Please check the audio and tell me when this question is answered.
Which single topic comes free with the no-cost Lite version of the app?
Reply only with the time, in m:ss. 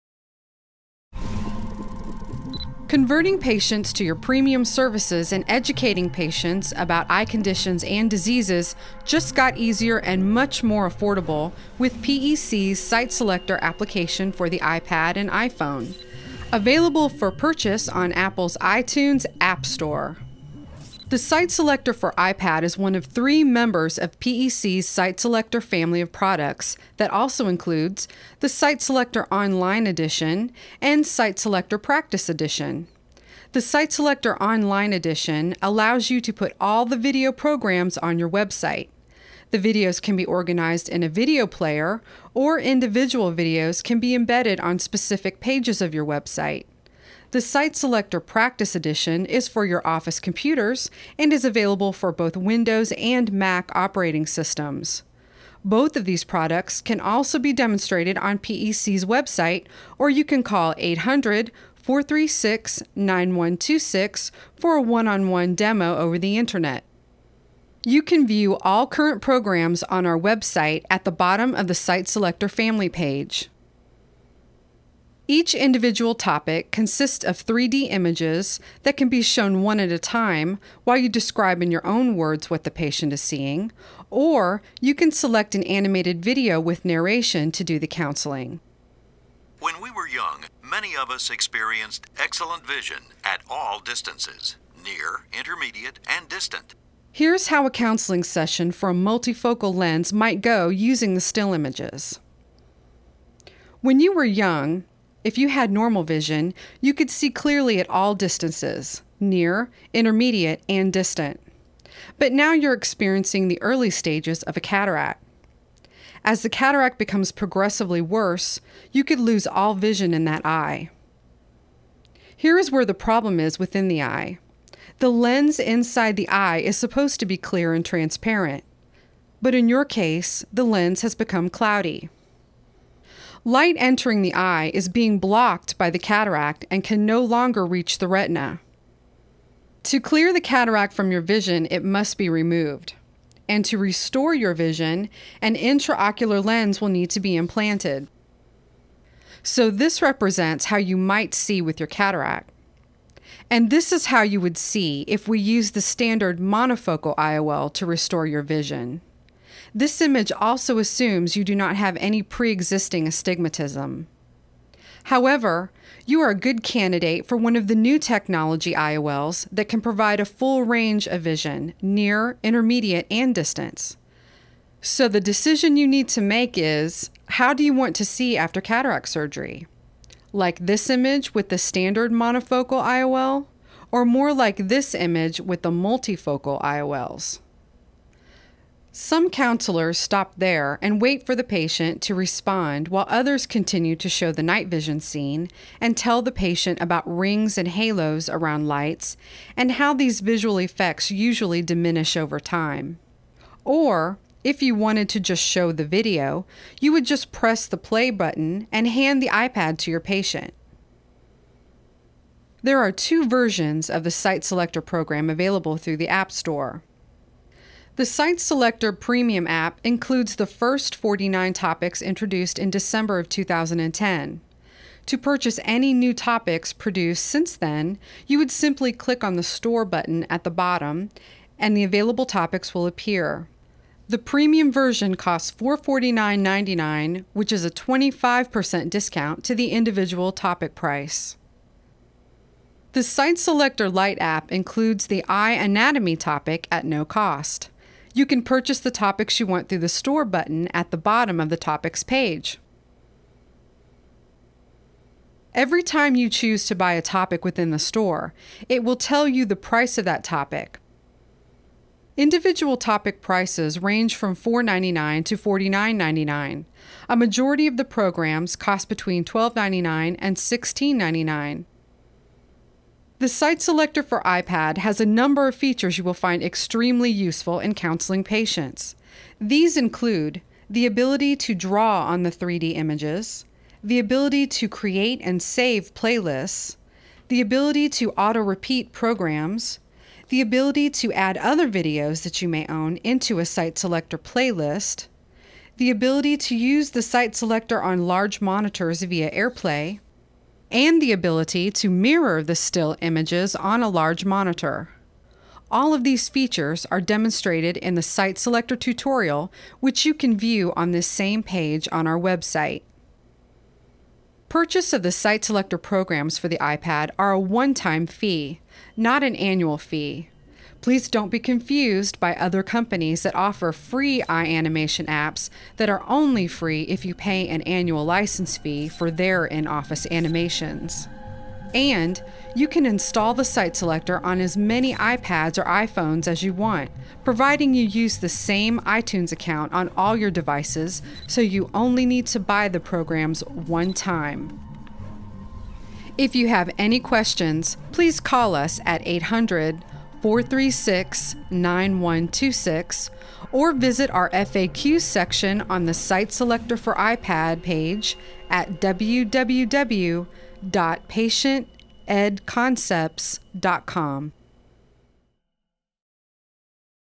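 4:05.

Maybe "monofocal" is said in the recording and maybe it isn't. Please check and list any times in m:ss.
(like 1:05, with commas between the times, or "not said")
2:36, 3:02.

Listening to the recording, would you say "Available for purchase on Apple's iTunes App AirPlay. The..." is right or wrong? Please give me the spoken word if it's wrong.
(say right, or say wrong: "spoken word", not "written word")
wrong: "Store", not "AirPlay".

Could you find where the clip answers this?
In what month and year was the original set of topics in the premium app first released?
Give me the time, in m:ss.
3:42.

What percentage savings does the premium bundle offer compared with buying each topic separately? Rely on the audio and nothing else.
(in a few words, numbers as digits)
25%.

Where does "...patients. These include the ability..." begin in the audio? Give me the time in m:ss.
4:38.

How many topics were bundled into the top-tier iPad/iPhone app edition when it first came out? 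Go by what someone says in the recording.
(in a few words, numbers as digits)
49.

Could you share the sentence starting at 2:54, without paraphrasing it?
So the decision you need to make is how do you want to see after cataract surgery?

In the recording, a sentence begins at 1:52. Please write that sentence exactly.
But now you're experiencing the early stages of a cataract.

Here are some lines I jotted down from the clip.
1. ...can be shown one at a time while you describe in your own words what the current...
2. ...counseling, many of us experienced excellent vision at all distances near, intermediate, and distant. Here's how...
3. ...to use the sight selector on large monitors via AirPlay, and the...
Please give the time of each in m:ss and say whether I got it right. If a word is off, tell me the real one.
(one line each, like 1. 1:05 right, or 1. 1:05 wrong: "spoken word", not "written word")
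1. 1:18 wrong: "patient", not "current"
2. 1:30 wrong: "young", not "counseling"
3. 4:56 right.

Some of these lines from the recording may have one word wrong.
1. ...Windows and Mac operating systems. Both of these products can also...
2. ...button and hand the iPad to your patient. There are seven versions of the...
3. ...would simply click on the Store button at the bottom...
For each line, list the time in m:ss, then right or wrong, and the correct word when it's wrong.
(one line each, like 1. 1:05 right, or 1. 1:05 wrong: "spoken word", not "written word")
1. 0:52 right
2. 3:28 wrong: "two", not "seven"
3. 3:48 right.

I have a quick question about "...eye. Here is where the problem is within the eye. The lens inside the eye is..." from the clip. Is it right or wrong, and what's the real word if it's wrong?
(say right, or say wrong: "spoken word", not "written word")
right.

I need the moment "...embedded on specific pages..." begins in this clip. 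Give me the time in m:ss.
0:44.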